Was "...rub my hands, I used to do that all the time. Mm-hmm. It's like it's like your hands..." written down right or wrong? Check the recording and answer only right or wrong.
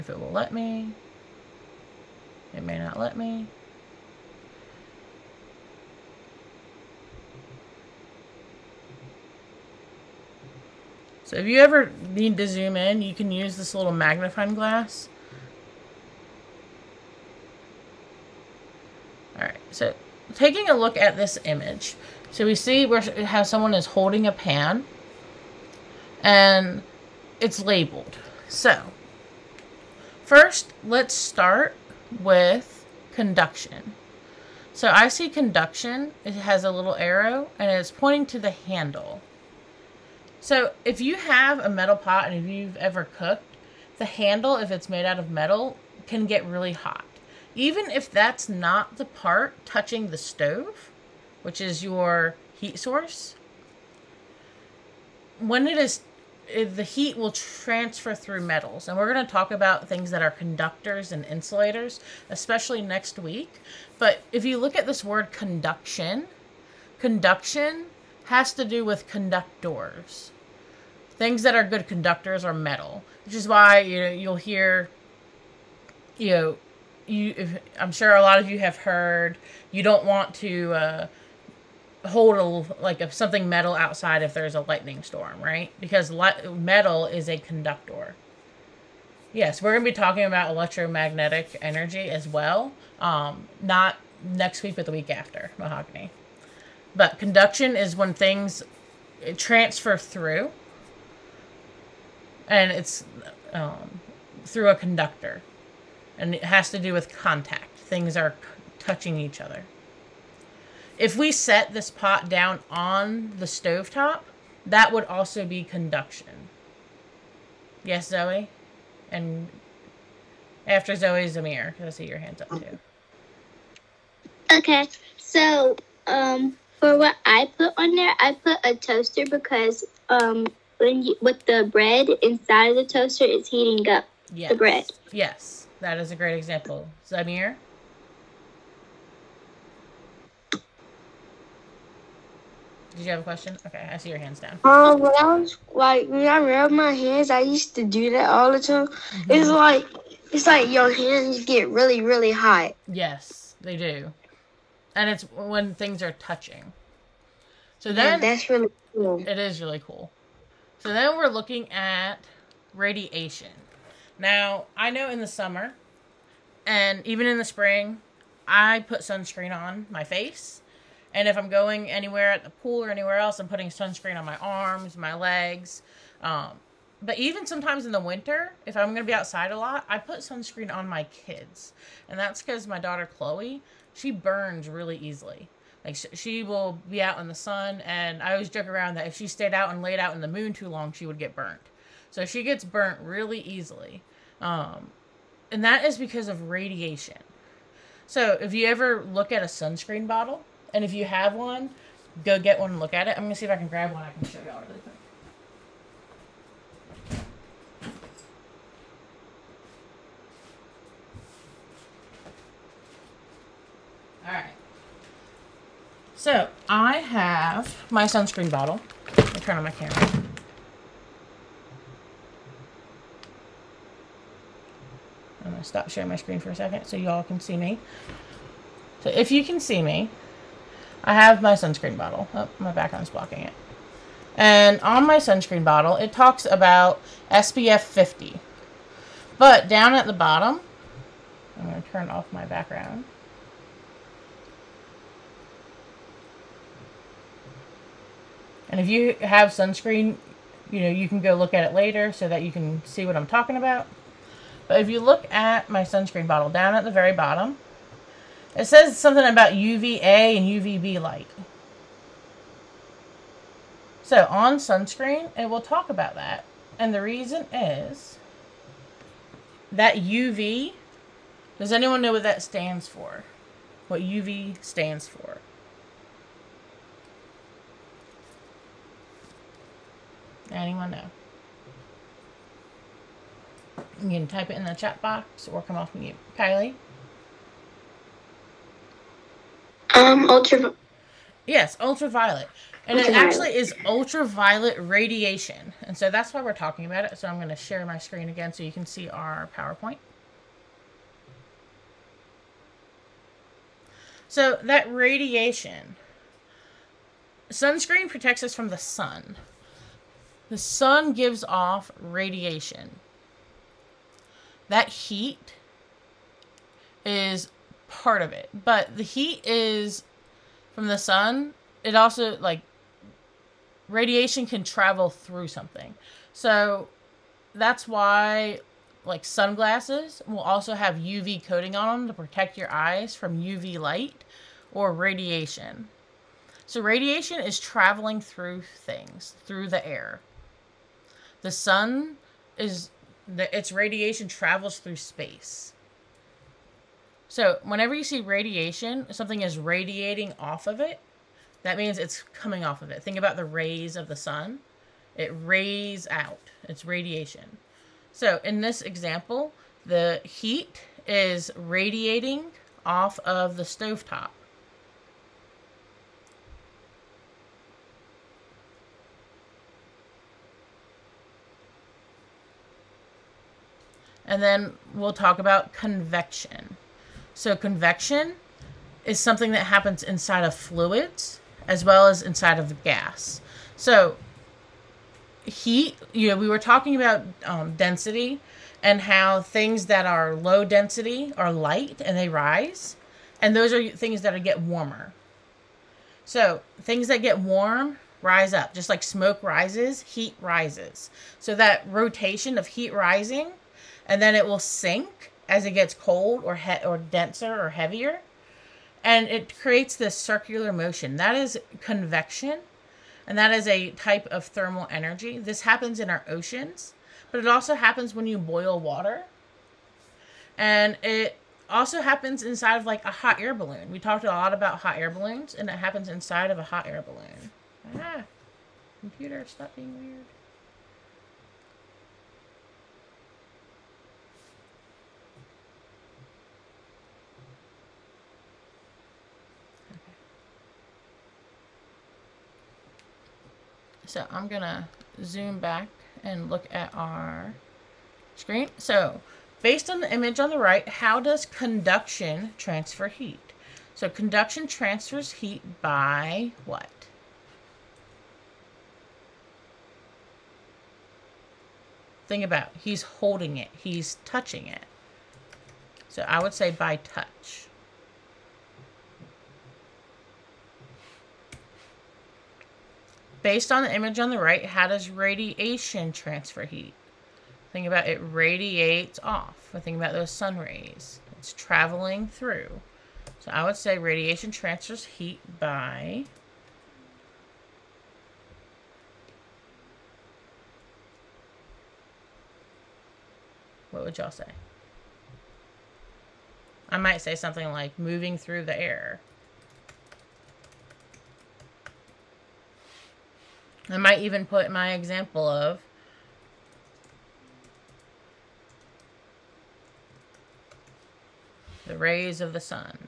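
right.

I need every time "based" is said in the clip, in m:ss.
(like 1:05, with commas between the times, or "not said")
7:29, 7:53.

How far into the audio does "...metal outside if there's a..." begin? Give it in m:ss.
1:23.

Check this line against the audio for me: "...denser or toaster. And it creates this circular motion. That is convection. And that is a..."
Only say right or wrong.
wrong.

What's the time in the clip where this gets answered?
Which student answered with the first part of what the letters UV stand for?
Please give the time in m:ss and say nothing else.
4:46.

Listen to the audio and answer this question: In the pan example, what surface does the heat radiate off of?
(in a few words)
the stovetop.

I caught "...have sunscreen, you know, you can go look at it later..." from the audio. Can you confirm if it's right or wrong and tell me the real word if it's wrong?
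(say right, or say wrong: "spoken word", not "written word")
right.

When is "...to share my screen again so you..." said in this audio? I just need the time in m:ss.
4:57.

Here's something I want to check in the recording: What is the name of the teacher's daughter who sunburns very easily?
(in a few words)
Chloe.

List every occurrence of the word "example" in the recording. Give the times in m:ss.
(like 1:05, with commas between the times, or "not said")
2:16, 5:58, 8:24.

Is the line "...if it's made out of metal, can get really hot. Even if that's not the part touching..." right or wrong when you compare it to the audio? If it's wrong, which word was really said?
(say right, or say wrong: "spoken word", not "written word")
right.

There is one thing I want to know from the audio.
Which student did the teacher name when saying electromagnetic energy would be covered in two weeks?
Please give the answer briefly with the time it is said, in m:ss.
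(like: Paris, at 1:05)
Mahogany, at 1:35.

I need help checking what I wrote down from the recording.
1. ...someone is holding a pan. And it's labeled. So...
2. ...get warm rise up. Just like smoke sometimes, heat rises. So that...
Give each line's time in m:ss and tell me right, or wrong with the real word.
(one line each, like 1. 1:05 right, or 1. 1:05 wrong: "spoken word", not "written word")
1. 0:23 right
2. 6:37 wrong: "rises", not "sometimes".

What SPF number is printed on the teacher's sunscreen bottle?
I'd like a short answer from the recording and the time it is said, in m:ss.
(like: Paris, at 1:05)
50, at 3:57.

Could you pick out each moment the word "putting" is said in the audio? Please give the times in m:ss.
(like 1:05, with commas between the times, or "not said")
2:53.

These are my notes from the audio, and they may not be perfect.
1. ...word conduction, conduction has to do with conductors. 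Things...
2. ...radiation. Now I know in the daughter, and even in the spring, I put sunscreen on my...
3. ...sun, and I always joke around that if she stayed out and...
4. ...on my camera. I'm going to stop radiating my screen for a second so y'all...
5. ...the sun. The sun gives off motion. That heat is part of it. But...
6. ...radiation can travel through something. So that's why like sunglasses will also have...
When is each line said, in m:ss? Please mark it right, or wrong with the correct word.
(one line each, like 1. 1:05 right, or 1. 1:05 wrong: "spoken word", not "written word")
1. 1:05 right
2. 2:42 wrong: "summer", not "daughter"
3. 3:07 right
4. 3:39 wrong: "sharing", not "radiating"
5. 5:08 wrong: "radiation", not "motion"
6. 5:23 right.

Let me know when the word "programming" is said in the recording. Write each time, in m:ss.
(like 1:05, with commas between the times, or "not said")
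not said.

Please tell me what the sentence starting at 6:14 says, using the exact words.
And then we'll talk about convection.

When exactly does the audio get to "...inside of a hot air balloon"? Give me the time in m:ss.
7:06.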